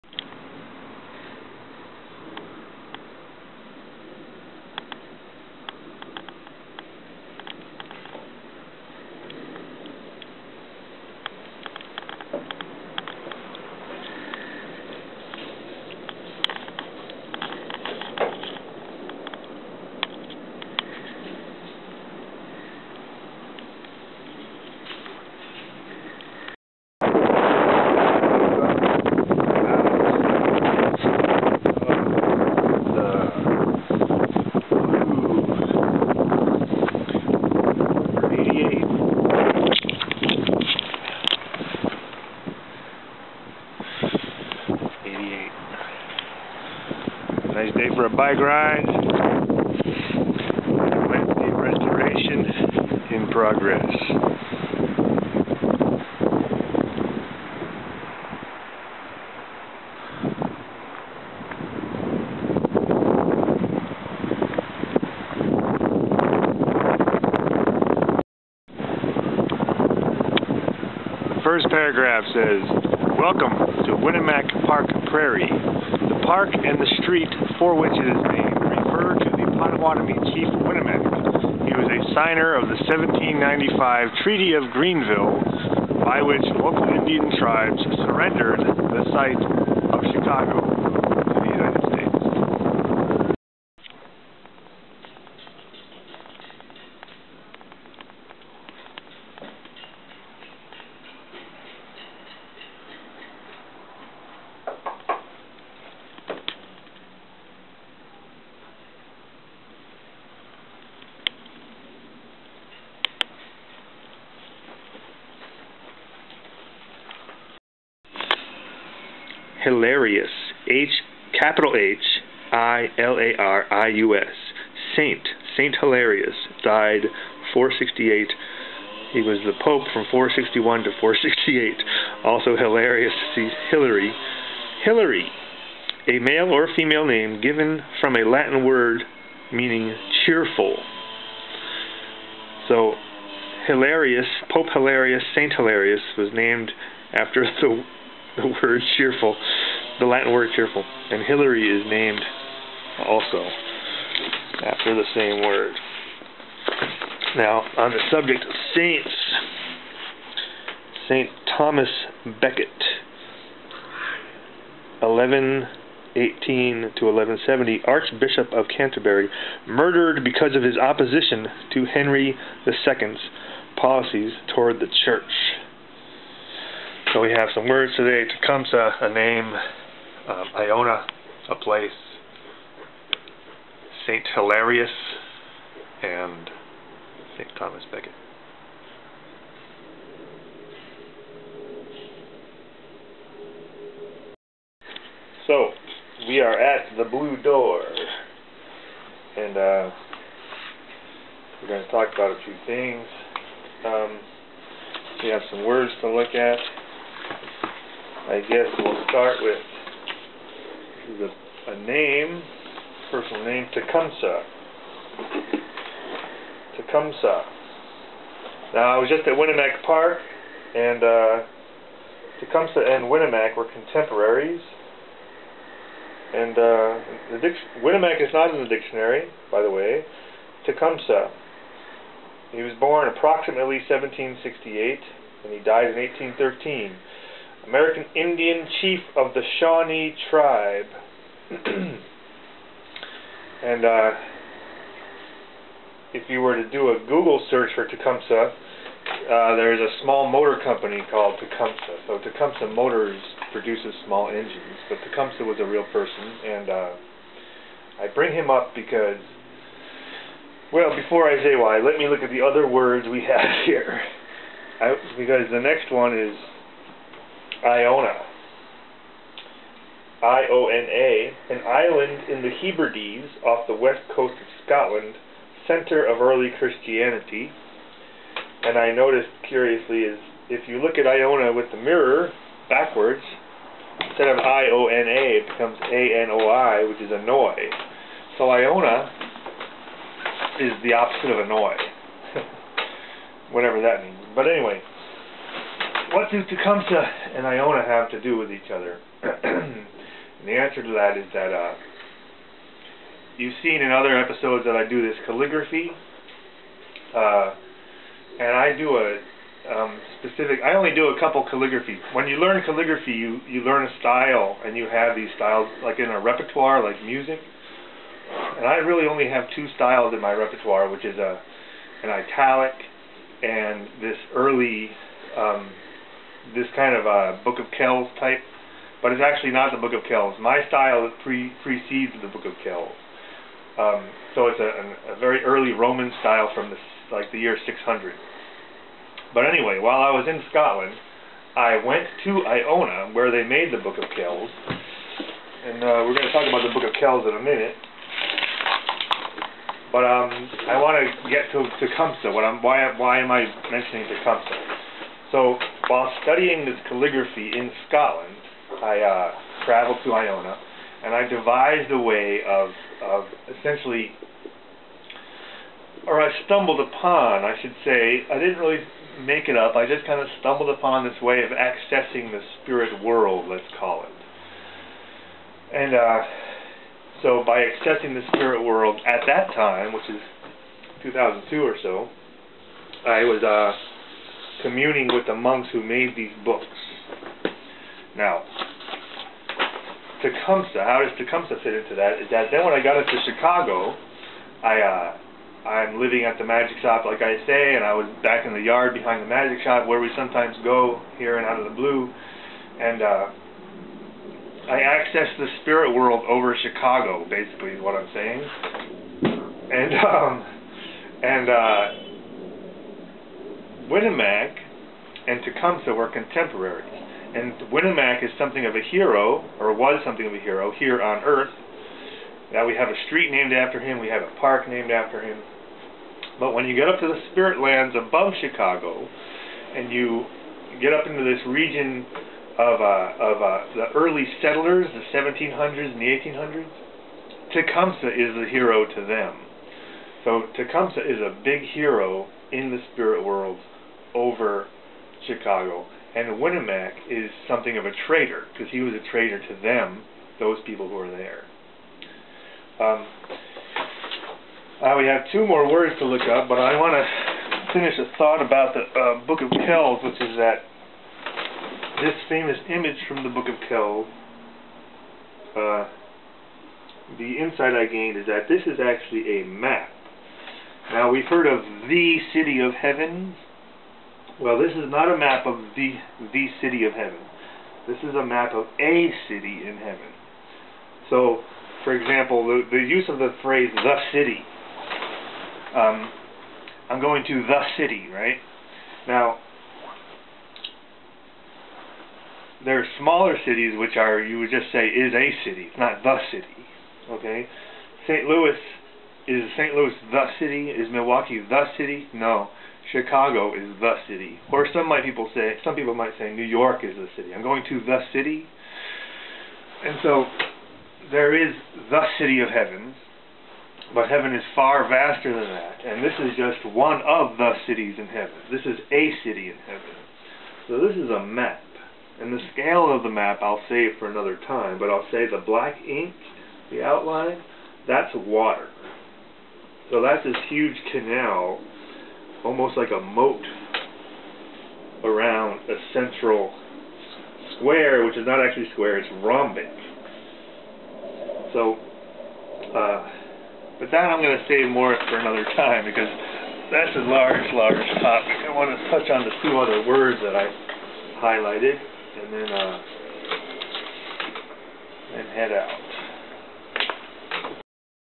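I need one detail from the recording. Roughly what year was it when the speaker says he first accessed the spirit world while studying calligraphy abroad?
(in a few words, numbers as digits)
2002.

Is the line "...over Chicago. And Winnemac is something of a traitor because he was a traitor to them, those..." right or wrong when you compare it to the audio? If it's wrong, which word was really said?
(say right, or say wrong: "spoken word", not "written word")
right.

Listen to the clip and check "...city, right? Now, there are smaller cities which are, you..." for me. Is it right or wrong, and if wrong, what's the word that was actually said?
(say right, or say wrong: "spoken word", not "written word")
right.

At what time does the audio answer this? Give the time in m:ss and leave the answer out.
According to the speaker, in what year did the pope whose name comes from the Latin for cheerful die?
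2:05.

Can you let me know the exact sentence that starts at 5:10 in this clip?
I only do a couple calligraphy.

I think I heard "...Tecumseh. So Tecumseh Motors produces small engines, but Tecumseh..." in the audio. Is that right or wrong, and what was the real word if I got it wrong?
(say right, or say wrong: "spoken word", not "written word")
right.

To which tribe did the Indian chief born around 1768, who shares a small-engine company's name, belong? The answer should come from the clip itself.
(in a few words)
Shawnee.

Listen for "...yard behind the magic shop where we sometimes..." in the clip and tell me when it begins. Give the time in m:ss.
6:38.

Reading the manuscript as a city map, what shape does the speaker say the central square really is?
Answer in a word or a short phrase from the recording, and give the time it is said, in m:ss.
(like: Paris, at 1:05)
rhombic, at 8:59.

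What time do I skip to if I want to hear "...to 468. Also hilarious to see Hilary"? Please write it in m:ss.
2:10.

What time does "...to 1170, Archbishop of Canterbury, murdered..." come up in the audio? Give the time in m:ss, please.
2:46.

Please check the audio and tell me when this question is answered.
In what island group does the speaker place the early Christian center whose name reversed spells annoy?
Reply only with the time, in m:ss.
4:32.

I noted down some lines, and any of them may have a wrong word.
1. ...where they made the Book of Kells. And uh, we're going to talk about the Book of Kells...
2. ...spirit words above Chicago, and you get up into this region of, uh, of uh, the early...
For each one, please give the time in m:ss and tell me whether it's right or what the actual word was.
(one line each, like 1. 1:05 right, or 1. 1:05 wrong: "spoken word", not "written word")
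1. 5:43 right
2. 7:07 wrong: "lands", not "words".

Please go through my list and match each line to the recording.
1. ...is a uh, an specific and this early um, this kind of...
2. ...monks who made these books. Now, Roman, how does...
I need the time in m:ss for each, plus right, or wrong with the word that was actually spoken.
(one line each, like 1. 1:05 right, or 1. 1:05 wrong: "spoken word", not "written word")
1. 5:21 wrong: "italic", not "specific"
2. 6:25 wrong: "Tecumseh", not "Roman".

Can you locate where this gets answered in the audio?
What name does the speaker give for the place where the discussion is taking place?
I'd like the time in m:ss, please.
3:16.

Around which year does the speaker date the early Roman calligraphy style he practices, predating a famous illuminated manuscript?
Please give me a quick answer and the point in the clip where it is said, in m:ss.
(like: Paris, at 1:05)
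600, at 5:37.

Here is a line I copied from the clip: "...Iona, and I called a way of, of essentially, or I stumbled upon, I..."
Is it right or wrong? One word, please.
wrong.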